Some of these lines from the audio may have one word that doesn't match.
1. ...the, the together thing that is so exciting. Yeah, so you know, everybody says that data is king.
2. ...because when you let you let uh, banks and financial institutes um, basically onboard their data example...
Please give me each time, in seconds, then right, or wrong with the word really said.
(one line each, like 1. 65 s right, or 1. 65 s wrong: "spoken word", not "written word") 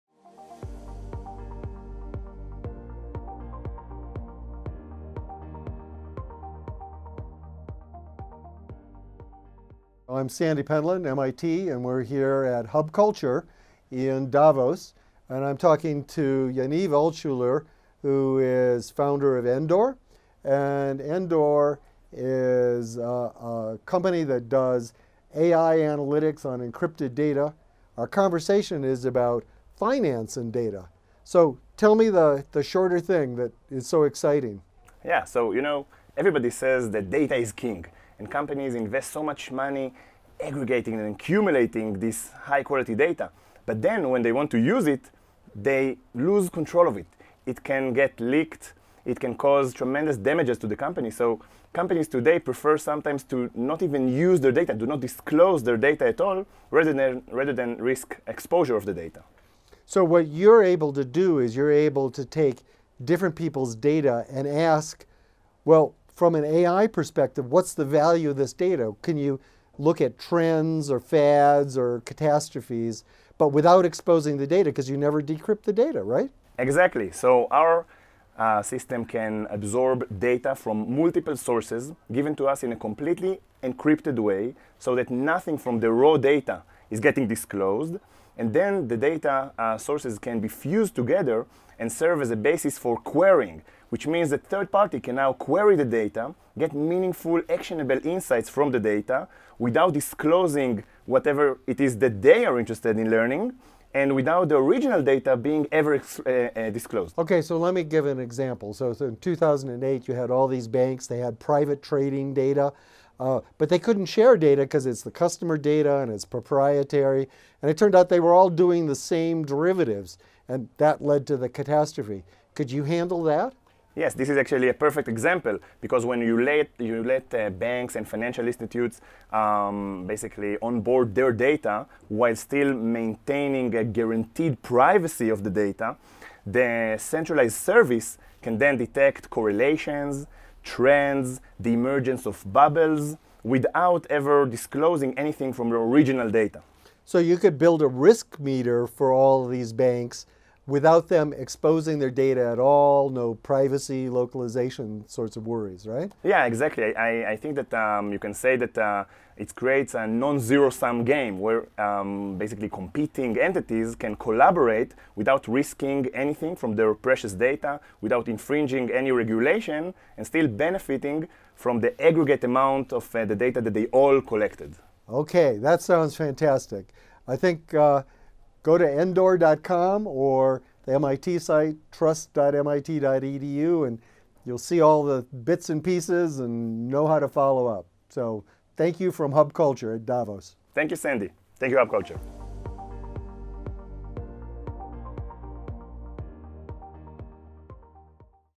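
1. 32 s wrong: "shorter", not "together"
2. 125 s wrong: "while", not "example".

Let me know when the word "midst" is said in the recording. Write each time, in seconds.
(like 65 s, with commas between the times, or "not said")
not said.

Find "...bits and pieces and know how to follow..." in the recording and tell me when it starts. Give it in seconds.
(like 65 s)
185 s.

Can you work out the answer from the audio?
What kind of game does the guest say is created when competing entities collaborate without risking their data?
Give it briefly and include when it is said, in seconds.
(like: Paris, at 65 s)
non-zero-sum game, at 160 s.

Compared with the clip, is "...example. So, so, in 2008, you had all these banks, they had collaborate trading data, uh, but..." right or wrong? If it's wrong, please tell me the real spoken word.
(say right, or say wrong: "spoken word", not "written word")
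wrong: "private", not "collaborate".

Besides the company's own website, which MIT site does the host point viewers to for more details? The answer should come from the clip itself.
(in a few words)
trust.mit.edu.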